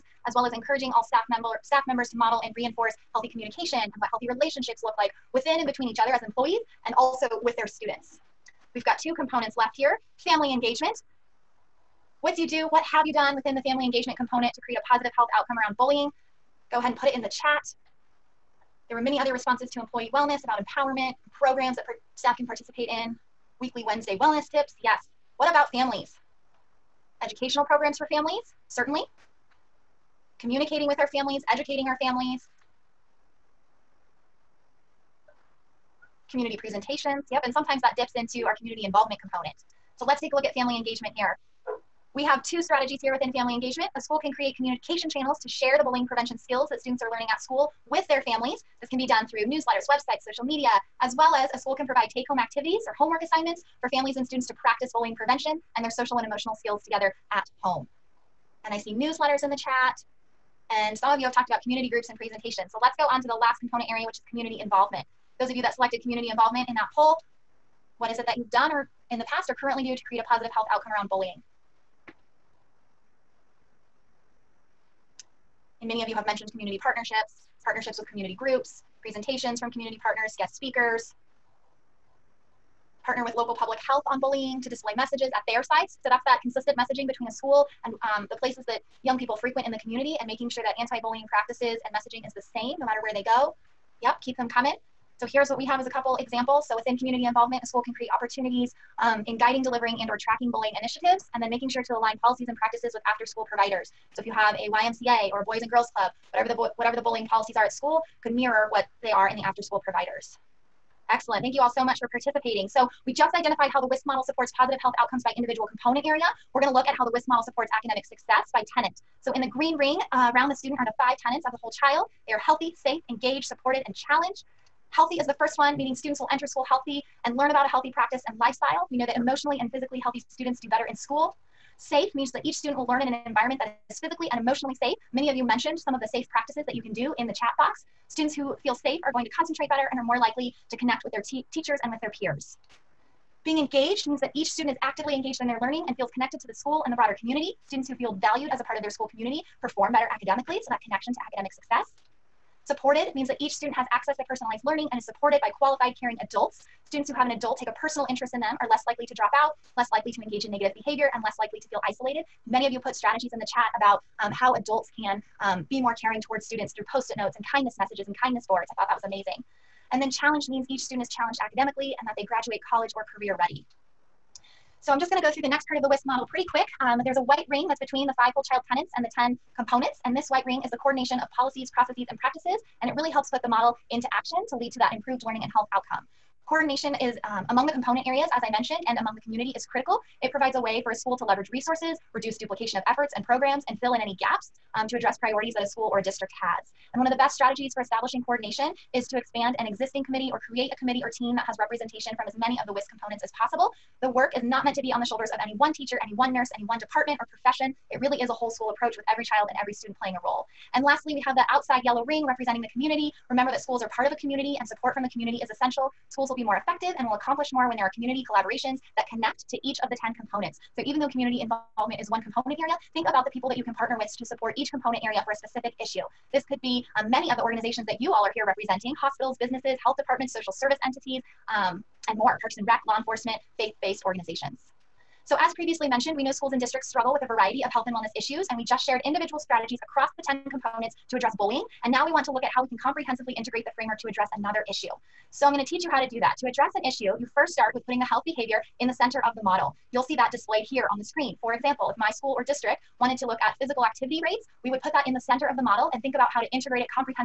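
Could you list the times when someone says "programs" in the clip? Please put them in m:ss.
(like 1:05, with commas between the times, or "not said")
0:21, 0:27, 3:13.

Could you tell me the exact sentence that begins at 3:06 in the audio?
Coordination is um, among the component areas, as I mentioned, and among the community is critical.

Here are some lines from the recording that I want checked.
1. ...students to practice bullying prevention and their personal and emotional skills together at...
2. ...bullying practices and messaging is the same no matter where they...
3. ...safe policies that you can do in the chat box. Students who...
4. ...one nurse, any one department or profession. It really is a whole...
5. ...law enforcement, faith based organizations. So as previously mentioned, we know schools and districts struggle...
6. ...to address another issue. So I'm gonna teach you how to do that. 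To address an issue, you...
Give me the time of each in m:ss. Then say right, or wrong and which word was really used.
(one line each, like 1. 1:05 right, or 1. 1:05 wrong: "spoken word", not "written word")
1. 0:54 wrong: "social", not "personal"
2. 1:31 right
3. 2:16 wrong: "practices", not "policies"
4. 3:26 right
5. 3:52 right
6. 4:04 right.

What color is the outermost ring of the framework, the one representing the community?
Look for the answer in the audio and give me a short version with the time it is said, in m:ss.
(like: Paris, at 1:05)
Yellow, at 3:31.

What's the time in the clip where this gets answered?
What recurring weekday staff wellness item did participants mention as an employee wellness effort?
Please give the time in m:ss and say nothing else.
0:23.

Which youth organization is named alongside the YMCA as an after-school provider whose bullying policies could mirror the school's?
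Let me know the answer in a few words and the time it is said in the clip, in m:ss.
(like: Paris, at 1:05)
Boys and Girls Club, at 1:45.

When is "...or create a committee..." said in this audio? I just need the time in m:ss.
3:20.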